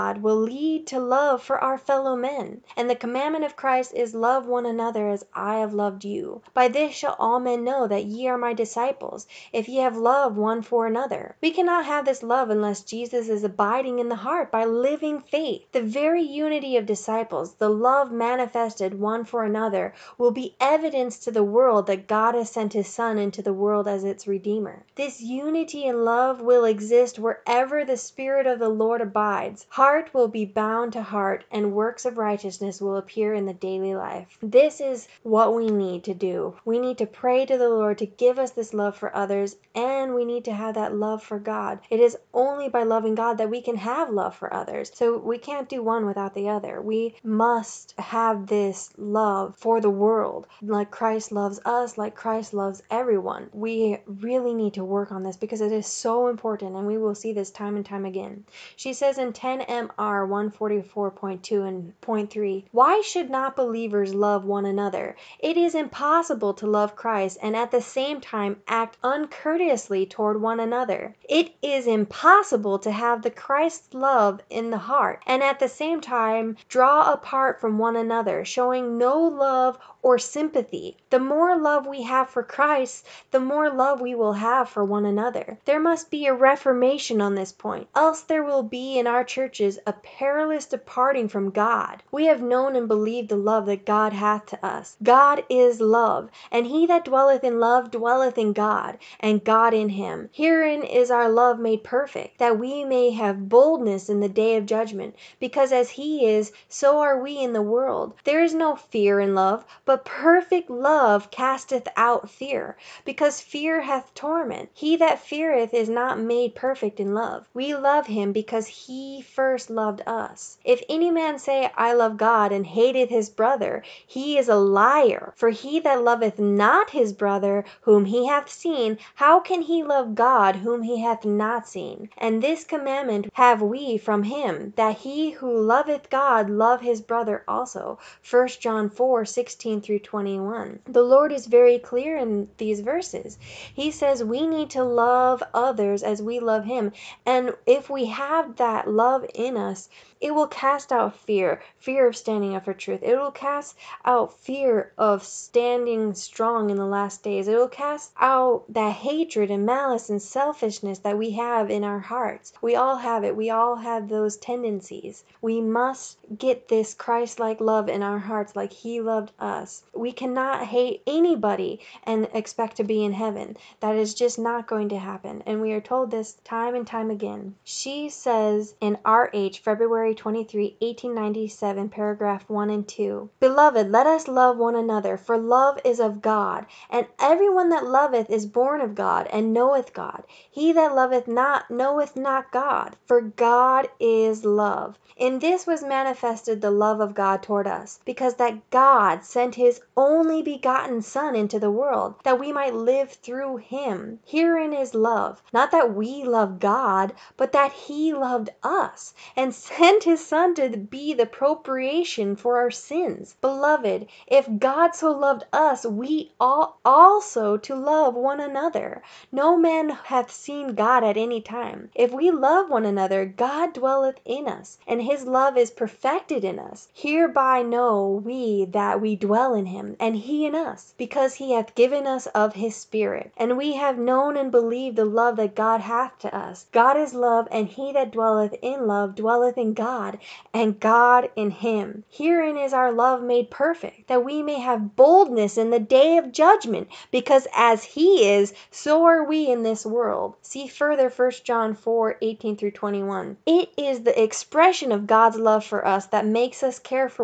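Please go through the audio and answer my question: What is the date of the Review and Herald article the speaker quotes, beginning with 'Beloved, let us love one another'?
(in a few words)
February 23, 1897.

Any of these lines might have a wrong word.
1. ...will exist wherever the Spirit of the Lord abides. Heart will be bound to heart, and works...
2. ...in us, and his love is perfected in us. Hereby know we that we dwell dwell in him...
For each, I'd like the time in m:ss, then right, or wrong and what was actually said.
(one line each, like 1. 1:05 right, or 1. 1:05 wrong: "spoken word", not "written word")
1. 0:26 right
2. 3:44 right.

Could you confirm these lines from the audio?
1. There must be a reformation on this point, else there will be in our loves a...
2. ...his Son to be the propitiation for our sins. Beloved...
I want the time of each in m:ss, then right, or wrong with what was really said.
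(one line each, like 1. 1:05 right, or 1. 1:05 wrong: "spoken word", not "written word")
1. 1:25 wrong: "churches", not "loves"
2. 3:30 right.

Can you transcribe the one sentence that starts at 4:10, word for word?
See further 1 John 4 18 through 21.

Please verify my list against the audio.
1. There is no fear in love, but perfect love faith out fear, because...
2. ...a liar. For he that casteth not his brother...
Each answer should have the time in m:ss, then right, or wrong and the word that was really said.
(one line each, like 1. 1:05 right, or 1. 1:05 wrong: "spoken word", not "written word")
1. 1:48 wrong: "casteth", not "faith"
2. 2:04 wrong: "loveth", not "casteth".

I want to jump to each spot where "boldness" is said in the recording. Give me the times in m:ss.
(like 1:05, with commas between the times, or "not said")
1:43, 4:04.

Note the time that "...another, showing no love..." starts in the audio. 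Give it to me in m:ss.
1:17.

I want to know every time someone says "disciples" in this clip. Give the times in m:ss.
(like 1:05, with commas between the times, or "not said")
0:08, 0:16.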